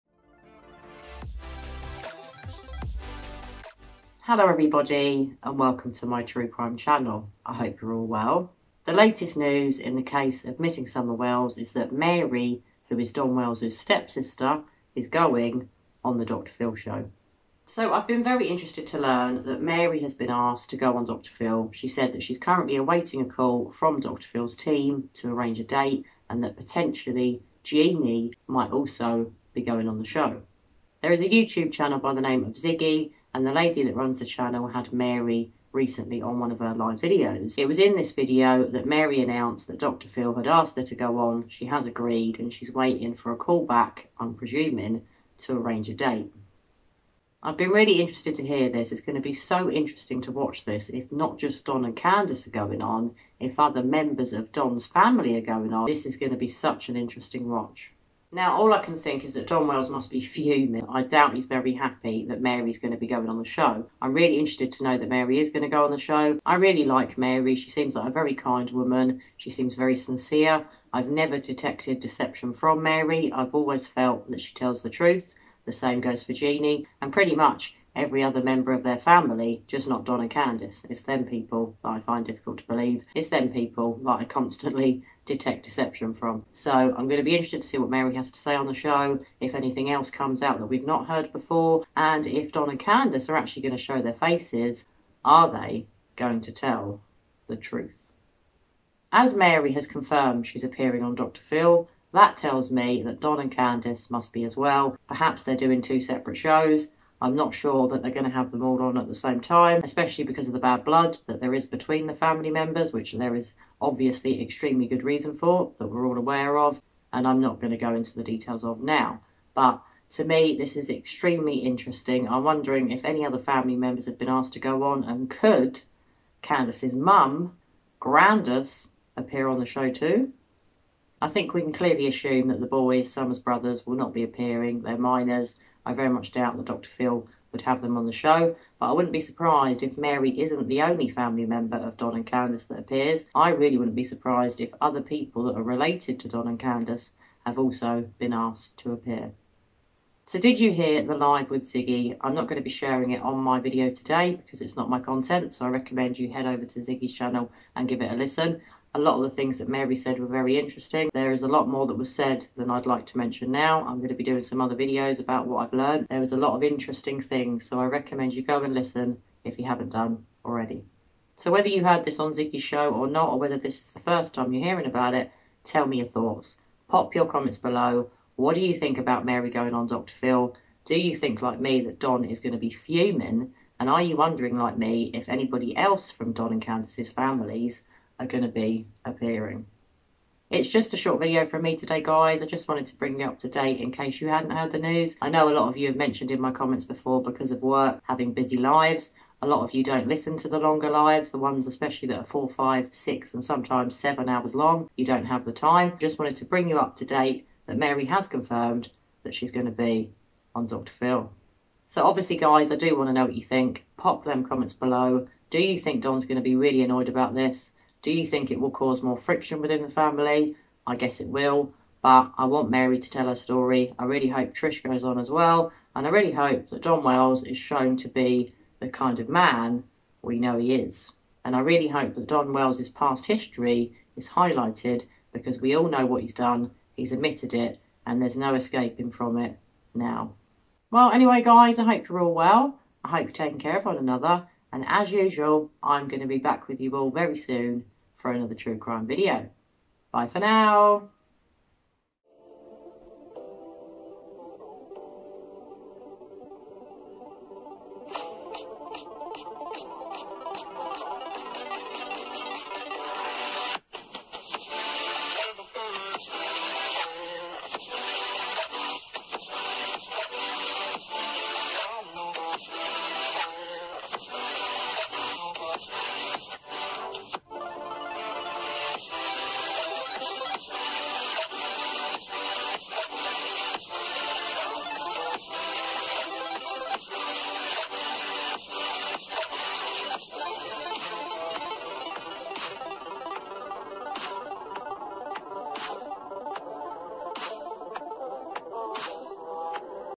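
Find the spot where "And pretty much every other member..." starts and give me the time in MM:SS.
01:17.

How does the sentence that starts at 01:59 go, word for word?
But to me, this is extremely interesting.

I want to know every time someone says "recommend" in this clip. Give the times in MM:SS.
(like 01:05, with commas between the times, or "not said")
02:35, 02:47.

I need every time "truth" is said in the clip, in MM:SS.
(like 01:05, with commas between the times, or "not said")
01:14, 01:37.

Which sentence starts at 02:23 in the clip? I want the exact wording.
I really wouldn't be surprised if other people that are related to Don and Candus have also been asked to appear.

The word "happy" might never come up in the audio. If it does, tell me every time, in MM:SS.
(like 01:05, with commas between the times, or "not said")
01:01.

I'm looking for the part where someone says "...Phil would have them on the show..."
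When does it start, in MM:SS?
02:16.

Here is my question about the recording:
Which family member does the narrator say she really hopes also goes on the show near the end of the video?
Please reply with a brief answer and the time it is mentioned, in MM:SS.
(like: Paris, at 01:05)
Trish, at 03:44.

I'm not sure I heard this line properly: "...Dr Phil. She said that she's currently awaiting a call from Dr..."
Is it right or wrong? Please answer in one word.
right.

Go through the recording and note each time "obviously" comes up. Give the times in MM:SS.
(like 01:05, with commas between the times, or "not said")
01:53, 03:32.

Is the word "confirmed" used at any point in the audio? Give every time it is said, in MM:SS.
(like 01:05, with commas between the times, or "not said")
01:39, 03:28.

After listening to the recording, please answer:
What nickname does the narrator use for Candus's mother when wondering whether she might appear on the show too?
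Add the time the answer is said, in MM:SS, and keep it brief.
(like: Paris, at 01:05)
Grandus, at 02:07.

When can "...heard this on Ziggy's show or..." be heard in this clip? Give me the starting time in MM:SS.
02:51.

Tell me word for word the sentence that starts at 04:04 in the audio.
And as usual, I'm going to be back with you all very soon for another true crime video.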